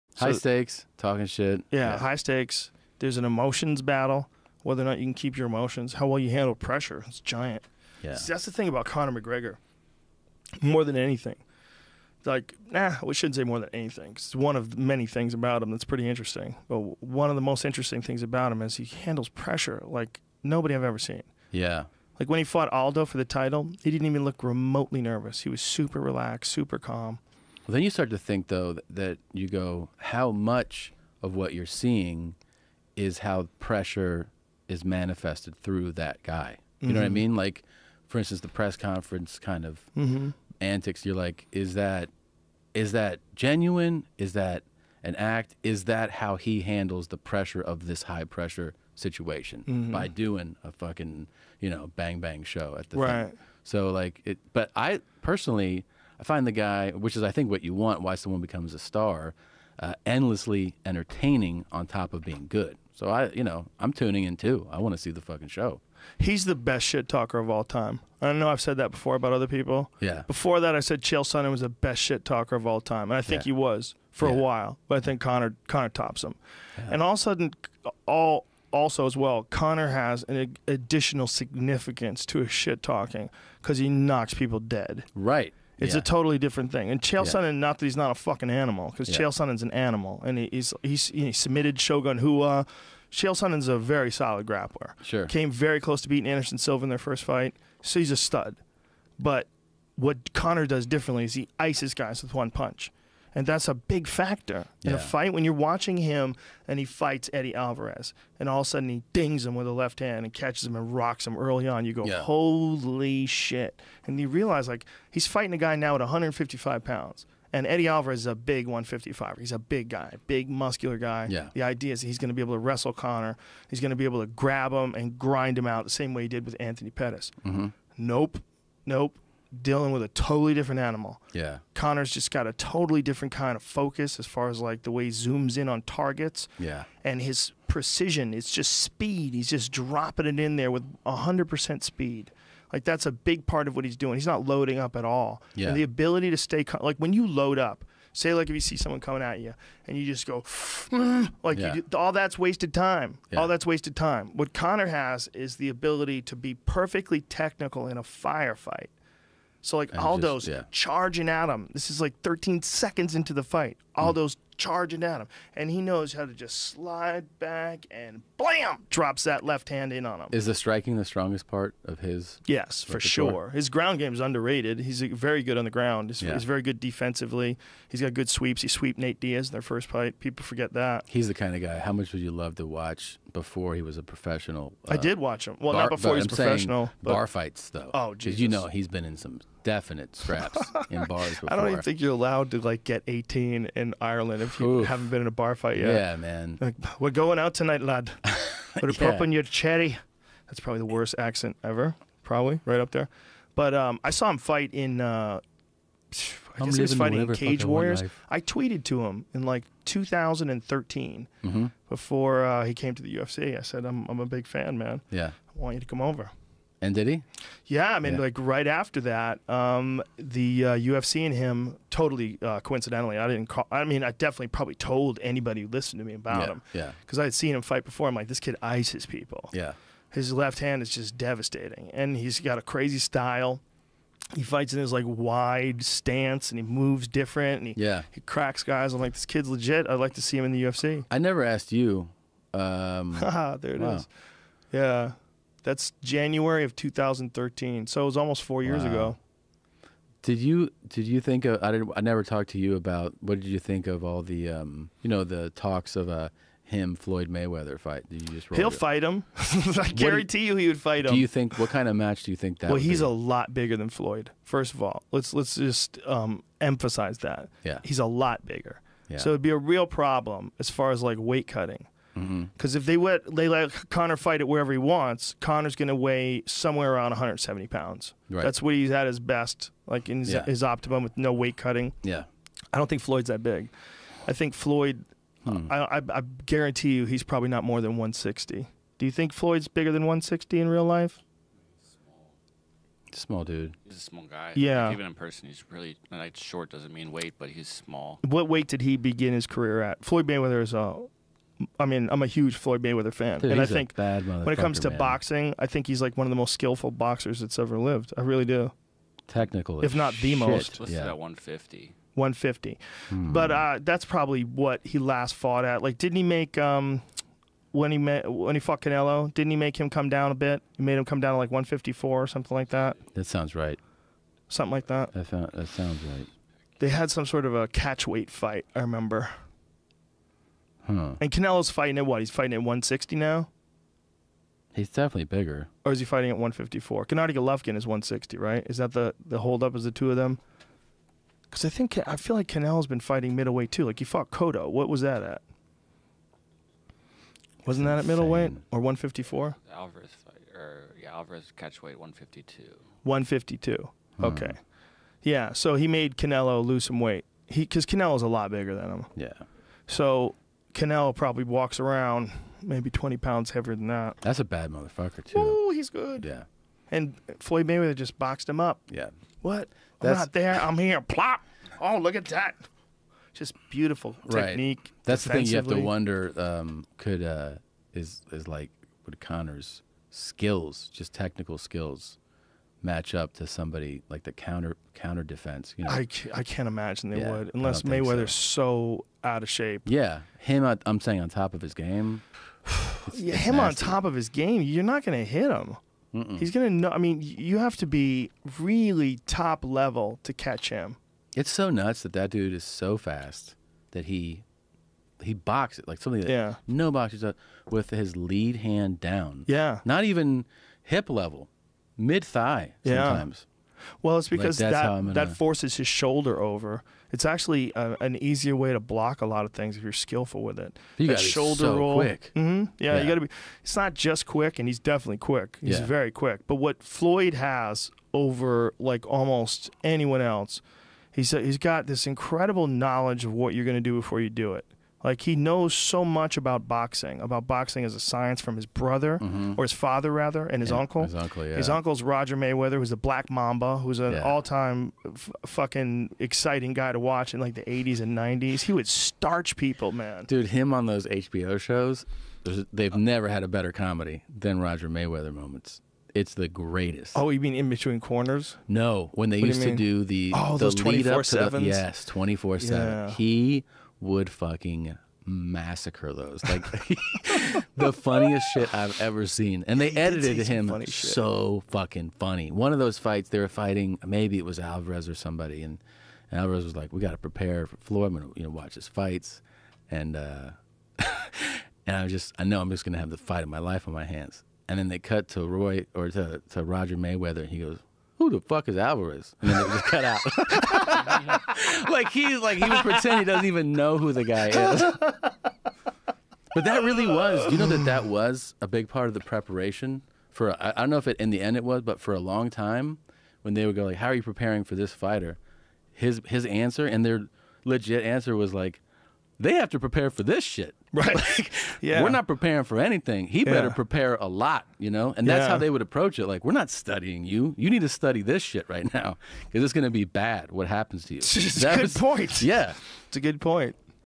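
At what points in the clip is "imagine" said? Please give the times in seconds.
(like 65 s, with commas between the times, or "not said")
386 s.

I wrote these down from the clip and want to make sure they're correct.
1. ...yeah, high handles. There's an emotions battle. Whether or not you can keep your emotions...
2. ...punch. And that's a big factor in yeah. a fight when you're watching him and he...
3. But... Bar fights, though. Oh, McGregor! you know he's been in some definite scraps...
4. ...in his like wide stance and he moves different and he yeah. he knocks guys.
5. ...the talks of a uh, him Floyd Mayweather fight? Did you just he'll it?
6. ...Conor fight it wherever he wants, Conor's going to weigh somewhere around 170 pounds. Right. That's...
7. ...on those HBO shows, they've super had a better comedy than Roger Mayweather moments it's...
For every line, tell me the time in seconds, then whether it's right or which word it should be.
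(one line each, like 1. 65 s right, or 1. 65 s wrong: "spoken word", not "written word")
1. 1 s wrong: "stakes", not "handles"
2. 102 s right
3. 187 s wrong: "Jesus", not "McGregor"
4. 234 s wrong: "cracks", not "knocks"
5. 255 s right
6. 273 s right
7. 450 s wrong: "never", not "super".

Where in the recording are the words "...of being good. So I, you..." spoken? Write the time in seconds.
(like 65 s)
62 s.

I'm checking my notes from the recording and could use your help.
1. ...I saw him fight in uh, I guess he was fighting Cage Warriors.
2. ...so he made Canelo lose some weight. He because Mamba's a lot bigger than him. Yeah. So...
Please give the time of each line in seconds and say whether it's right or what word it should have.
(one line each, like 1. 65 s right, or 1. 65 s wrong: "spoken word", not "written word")
1. 204 s right
2. 355 s wrong: "Canelo", not "Mamba".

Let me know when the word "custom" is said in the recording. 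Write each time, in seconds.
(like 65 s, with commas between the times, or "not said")
not said.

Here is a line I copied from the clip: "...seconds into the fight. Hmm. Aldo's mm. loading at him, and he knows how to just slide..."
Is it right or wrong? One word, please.
wrong.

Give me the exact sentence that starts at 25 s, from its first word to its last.
He was super relaxed, super calm.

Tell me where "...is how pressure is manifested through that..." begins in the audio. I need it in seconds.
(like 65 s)
32 s.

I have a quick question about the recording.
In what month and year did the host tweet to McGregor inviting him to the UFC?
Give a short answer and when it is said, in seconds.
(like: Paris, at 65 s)
January 2013, at 246 s.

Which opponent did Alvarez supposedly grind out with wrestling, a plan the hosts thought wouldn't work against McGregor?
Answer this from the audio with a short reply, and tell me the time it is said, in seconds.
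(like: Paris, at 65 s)
Anthony Pettis, at 126 s.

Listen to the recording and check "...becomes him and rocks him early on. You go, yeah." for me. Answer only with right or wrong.
wrong.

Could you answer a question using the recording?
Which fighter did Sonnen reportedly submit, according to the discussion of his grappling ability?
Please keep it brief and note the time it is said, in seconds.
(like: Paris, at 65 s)
Shogun Rua, at 91 s.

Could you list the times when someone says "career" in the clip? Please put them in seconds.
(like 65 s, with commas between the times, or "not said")
299 s.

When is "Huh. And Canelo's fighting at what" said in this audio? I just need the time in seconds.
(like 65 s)
330 s.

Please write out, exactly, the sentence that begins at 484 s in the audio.
And then they cut to Roy or to to Roger Mayweather, and he goes, the fuck is Alvarez?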